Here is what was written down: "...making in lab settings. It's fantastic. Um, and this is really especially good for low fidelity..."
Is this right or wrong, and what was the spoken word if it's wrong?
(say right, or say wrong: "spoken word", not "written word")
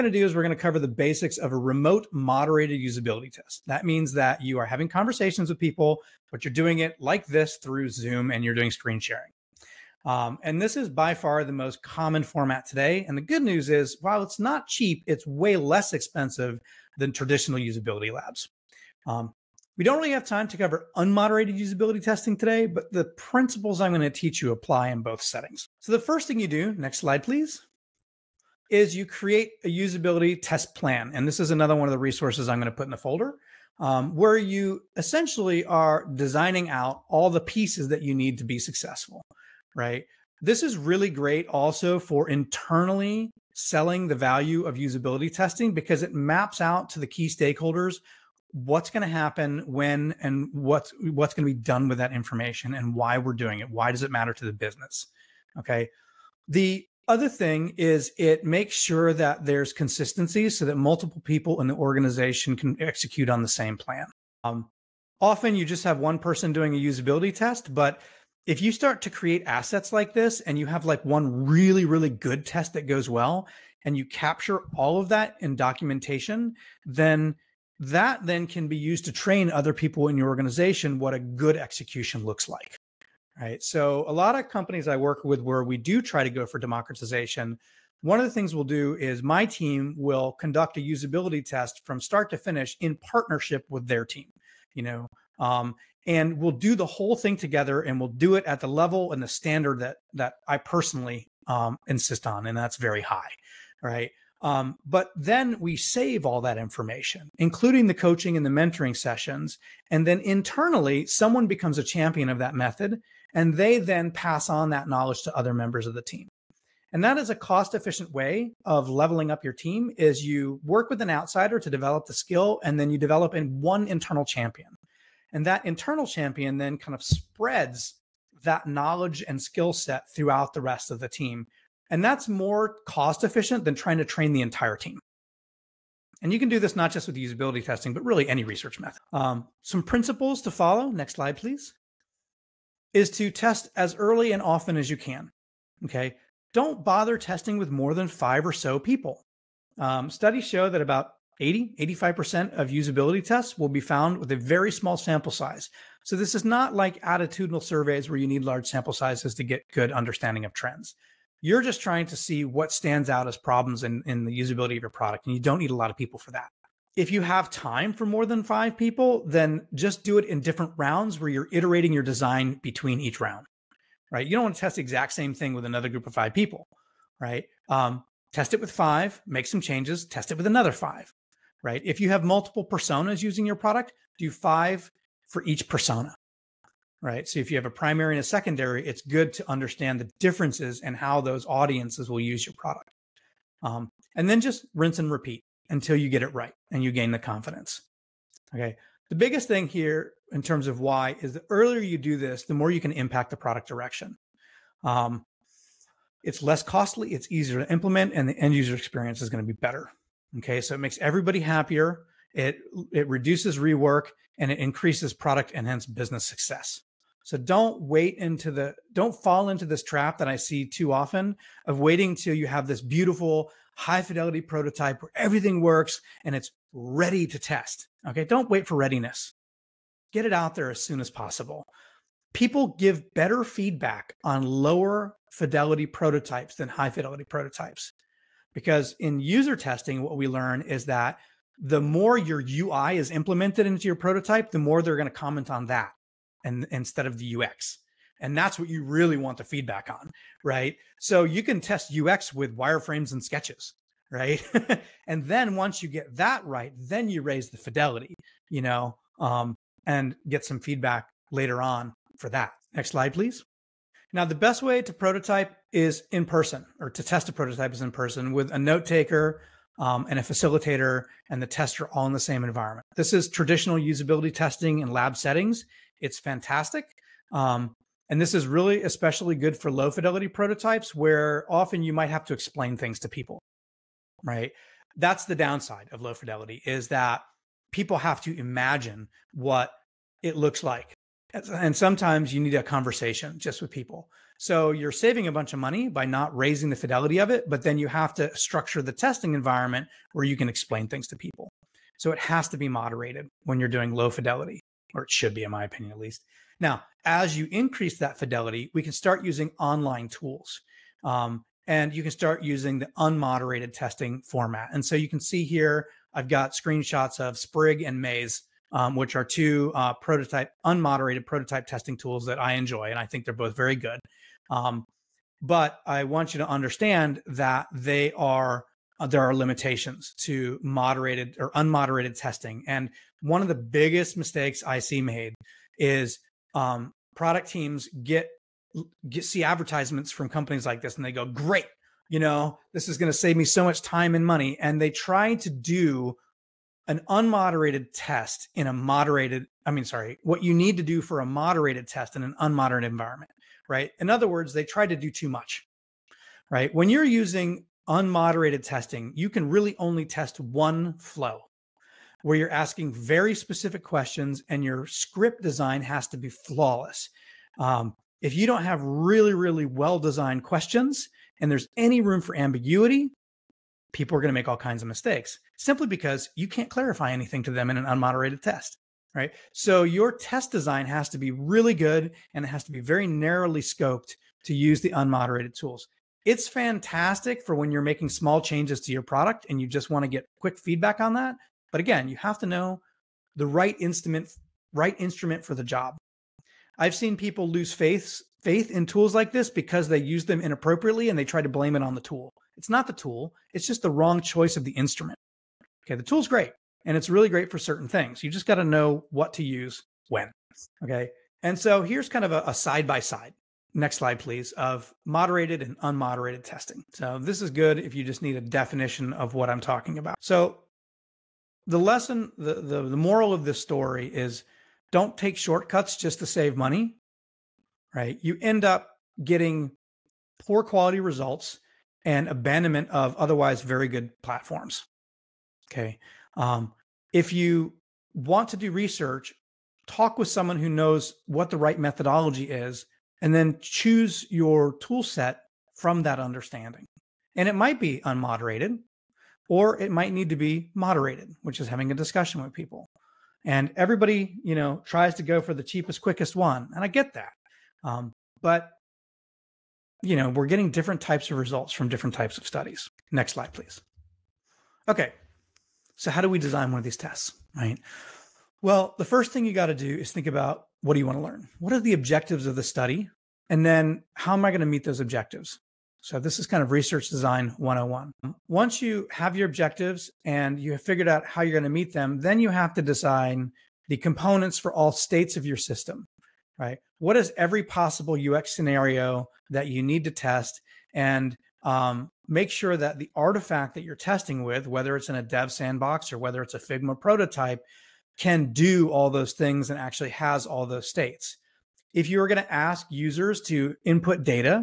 wrong: "testing", not "making".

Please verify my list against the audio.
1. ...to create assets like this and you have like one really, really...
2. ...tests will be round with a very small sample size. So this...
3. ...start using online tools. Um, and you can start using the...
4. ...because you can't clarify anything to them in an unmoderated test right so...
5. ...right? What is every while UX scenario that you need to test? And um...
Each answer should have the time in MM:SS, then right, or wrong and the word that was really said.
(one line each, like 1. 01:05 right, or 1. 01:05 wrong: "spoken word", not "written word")
1. 01:09 right
2. 02:33 wrong: "found", not "round"
3. 05:08 right
4. 06:15 right
5. 08:06 wrong: "possible", not "while".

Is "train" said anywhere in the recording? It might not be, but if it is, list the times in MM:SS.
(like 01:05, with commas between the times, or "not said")
01:19, 02:14.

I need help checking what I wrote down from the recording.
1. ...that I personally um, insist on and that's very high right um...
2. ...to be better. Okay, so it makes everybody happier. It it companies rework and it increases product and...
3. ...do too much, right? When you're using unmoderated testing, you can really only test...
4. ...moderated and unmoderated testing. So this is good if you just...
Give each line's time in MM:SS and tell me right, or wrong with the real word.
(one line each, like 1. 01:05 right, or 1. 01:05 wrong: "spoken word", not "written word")
1. 01:40 right
2. 03:29 wrong: "reduces", not "companies"
3. 05:54 right
4. 06:55 right.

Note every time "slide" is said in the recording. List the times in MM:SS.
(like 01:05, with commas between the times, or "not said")
00:26, 02:21, 04:22, 06:53, 07:43.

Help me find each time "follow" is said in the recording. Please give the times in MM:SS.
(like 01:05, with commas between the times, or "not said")
02:20.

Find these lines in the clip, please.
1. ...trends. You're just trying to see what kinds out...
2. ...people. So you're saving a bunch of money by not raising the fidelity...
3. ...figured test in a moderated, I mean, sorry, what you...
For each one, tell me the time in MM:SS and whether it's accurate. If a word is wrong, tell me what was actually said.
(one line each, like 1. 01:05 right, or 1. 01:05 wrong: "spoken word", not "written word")
1. 02:40 wrong: "stands", not "kinds"
2. 04:53 right
3. 05:47 wrong: "unmoderated", not "figured".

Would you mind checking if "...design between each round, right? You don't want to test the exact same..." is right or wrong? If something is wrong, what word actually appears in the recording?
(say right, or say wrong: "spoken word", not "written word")
right.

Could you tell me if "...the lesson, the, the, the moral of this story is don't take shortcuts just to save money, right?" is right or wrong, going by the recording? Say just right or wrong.
right.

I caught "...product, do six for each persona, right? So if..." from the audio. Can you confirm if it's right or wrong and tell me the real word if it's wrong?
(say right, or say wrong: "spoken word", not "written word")
wrong: "five", not "six".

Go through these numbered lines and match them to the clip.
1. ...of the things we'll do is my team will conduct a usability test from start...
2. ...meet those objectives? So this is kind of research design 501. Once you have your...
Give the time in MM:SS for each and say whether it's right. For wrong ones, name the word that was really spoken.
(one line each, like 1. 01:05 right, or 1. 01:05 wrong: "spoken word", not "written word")
1. 01:28 right
2. 07:54 wrong: "101", not "501".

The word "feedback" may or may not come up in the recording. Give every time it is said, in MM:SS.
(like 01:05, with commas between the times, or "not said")
03:53, 04:09, 04:20, 06:30.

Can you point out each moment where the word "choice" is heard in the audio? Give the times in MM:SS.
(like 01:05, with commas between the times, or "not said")
06:44.